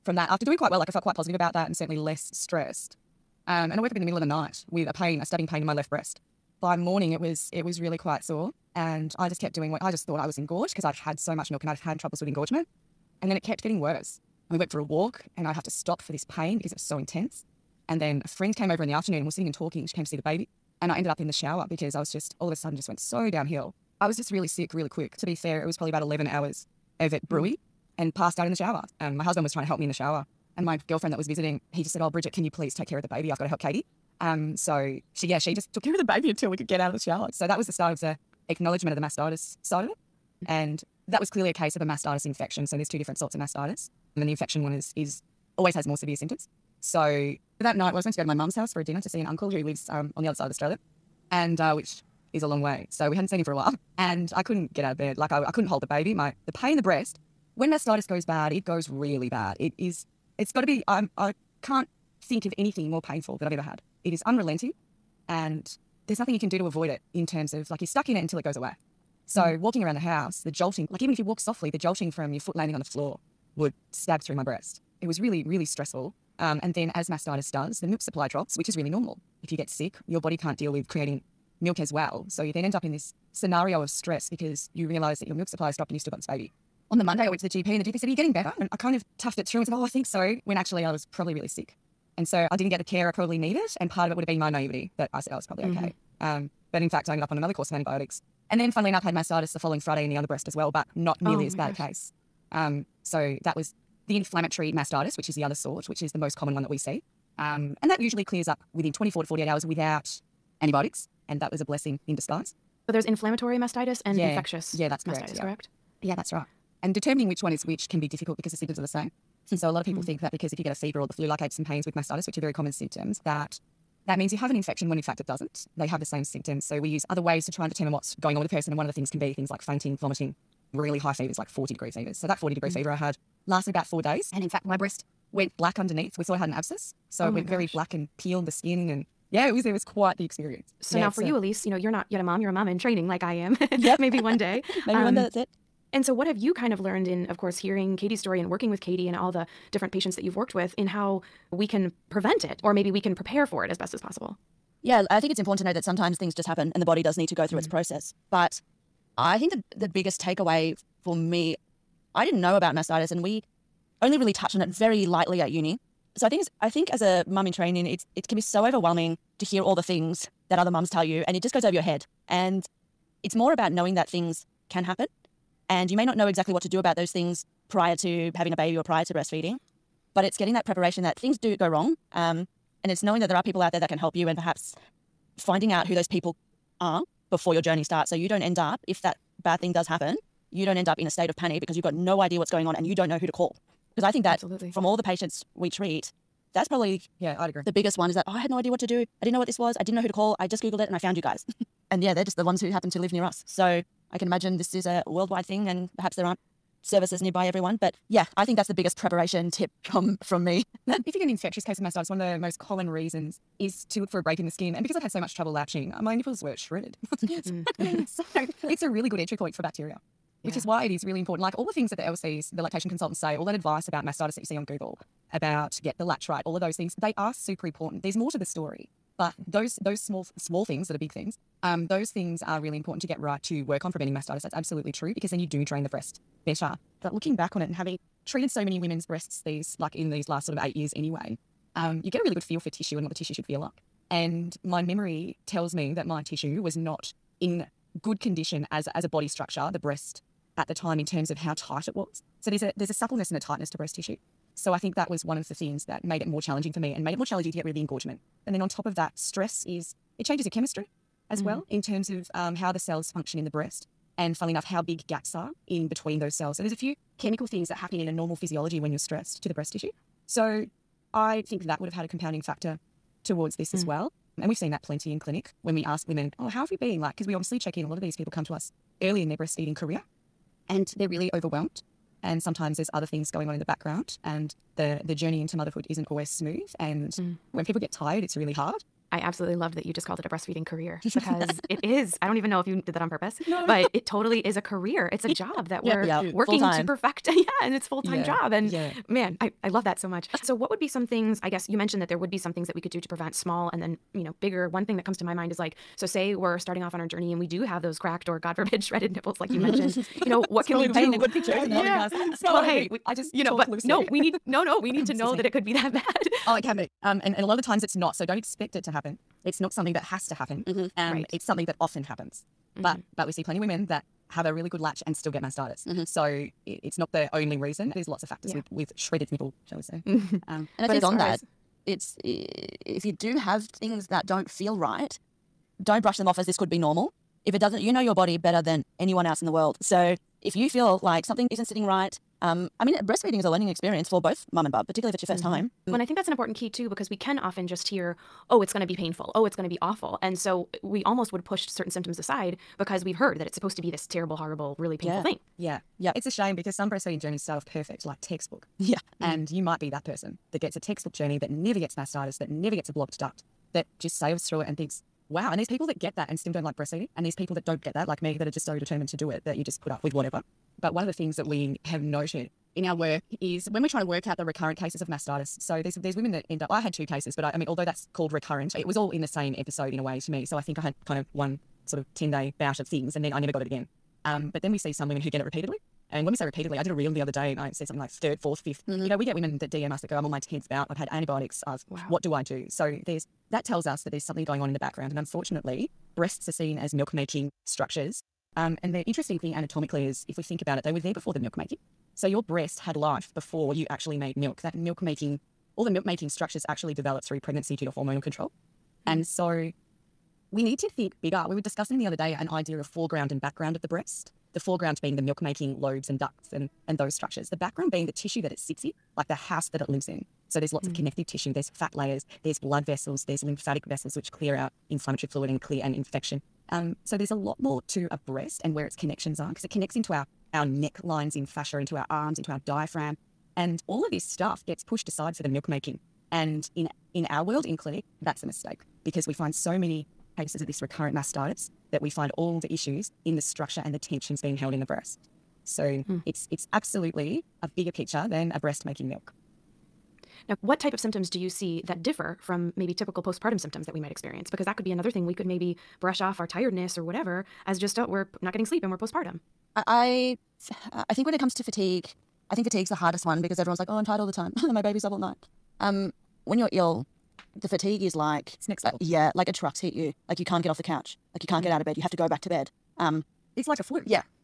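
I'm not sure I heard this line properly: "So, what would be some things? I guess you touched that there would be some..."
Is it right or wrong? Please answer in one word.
wrong.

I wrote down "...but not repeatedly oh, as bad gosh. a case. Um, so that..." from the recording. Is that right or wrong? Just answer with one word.
wrong.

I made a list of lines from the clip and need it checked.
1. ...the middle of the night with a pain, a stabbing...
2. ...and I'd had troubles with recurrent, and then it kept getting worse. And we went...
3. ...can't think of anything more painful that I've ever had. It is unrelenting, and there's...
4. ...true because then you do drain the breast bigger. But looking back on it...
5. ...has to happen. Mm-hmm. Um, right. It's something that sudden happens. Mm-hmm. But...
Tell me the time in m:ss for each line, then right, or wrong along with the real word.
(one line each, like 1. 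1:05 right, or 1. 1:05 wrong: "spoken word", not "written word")
1. 0:04 right
2. 0:11 wrong: "engorgement", not "recurrent"
3. 1:01 right
4. 3:54 wrong: "better", not "bigger"
5. 5:20 wrong: "often", not "sudden".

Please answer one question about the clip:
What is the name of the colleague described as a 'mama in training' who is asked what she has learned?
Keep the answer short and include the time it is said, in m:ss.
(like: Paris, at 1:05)
Elise, at 2:21.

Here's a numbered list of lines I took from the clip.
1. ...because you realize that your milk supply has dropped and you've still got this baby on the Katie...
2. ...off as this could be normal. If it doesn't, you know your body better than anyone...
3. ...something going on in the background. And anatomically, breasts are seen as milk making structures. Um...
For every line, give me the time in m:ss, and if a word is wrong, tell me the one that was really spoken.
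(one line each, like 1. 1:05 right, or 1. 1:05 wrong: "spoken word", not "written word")
1. 1:24 wrong: "Monday", not "Katie"
2. 5:36 right
3. 6:34 wrong: "unfortunately", not "anatomically".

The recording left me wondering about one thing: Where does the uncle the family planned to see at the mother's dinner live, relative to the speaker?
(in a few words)
Other side of Australia.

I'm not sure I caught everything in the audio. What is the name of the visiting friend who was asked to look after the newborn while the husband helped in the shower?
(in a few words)
Bridget.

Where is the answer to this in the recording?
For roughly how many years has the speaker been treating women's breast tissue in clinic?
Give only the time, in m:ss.
4:00.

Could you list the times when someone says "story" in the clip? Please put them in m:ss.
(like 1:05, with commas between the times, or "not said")
2:28, 3:48.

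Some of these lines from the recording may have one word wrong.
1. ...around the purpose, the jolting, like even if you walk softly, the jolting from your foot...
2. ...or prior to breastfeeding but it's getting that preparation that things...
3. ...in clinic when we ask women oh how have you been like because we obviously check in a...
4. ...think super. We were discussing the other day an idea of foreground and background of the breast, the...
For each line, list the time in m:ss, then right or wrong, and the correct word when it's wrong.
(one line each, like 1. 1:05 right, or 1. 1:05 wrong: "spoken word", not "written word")
1. 1:09 wrong: "house", not "purpose"
2. 2:58 right
3. 4:35 right
4. 6:50 wrong: "bigger", not "super".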